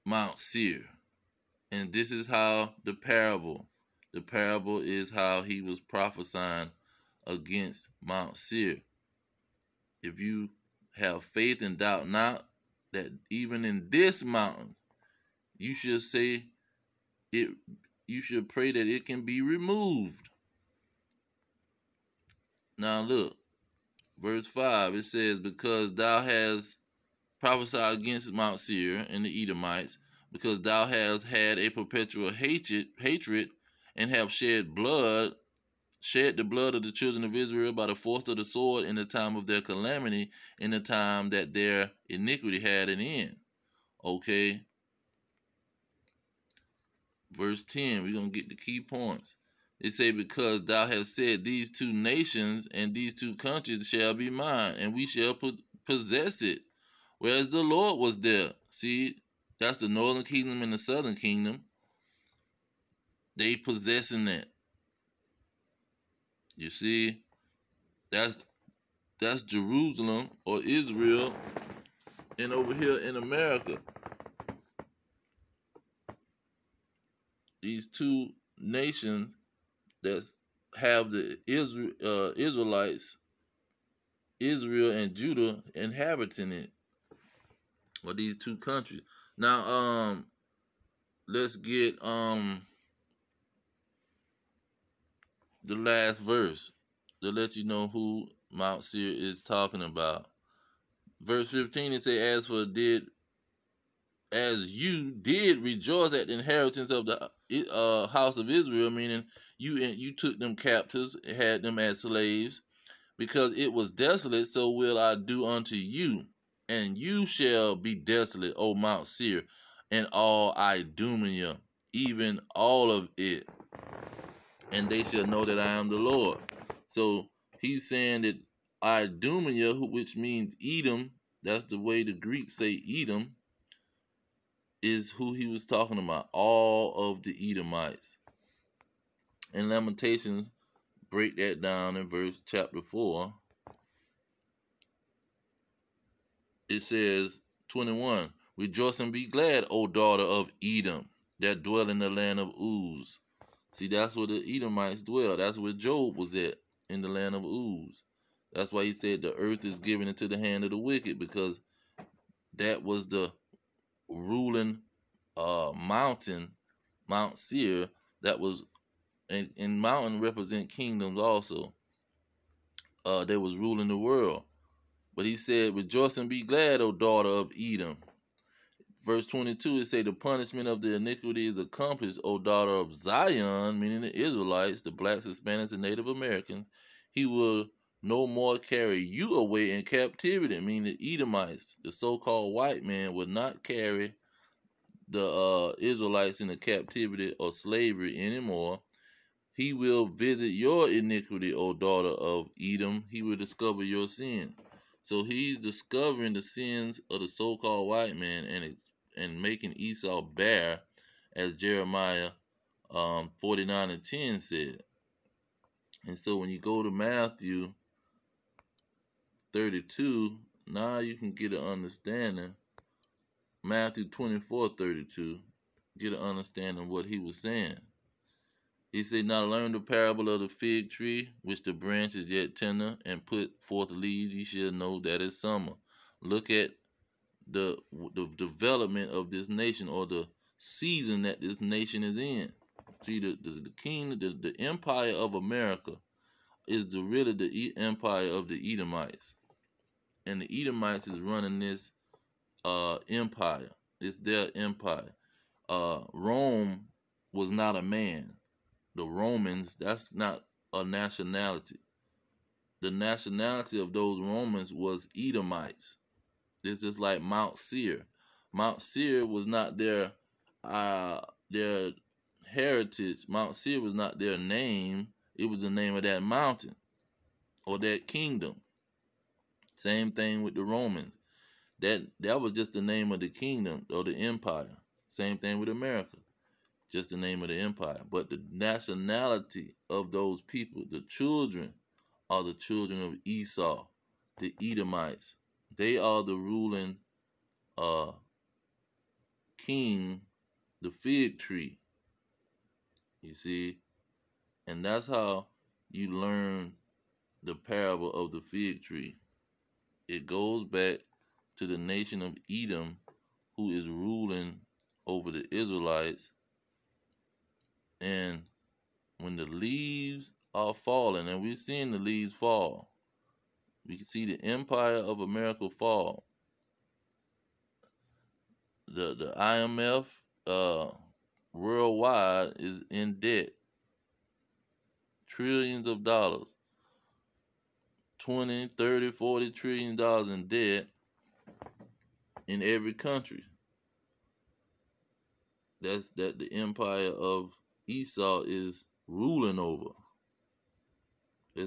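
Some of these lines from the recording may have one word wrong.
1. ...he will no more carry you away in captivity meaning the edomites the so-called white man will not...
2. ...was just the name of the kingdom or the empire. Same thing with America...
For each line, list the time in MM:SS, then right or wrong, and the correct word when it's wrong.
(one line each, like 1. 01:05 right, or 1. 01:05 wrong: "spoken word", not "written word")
1. 03:07 right
2. 04:42 right.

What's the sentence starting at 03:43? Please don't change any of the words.
Matthew 24, 32, get an understanding what he was saying.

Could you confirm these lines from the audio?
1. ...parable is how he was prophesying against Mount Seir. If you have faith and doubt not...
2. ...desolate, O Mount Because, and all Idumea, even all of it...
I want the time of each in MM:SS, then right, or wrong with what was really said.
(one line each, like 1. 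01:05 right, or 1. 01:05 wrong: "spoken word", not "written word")
1. 00:04 right
2. 01:57 wrong: "Seir", not "Because".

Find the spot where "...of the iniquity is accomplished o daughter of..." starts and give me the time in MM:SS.
03:00.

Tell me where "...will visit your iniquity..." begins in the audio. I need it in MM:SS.
03:19.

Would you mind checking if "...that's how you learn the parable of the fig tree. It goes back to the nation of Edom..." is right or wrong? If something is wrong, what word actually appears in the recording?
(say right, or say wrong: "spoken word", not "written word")
right.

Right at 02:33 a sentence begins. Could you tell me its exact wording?
See, that's where the Edomites dwell.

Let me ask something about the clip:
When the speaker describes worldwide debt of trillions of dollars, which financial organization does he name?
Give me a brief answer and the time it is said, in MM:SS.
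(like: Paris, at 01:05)
IMF, at 05:29.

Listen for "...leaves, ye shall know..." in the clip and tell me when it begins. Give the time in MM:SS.
03:53.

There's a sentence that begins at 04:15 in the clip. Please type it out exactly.
Uh, Rome was not a man the Romans, that's not a nationality.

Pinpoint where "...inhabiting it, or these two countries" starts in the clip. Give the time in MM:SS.
01:25.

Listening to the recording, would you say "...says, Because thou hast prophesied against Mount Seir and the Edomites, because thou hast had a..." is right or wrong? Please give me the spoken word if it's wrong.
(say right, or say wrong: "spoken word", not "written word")
right.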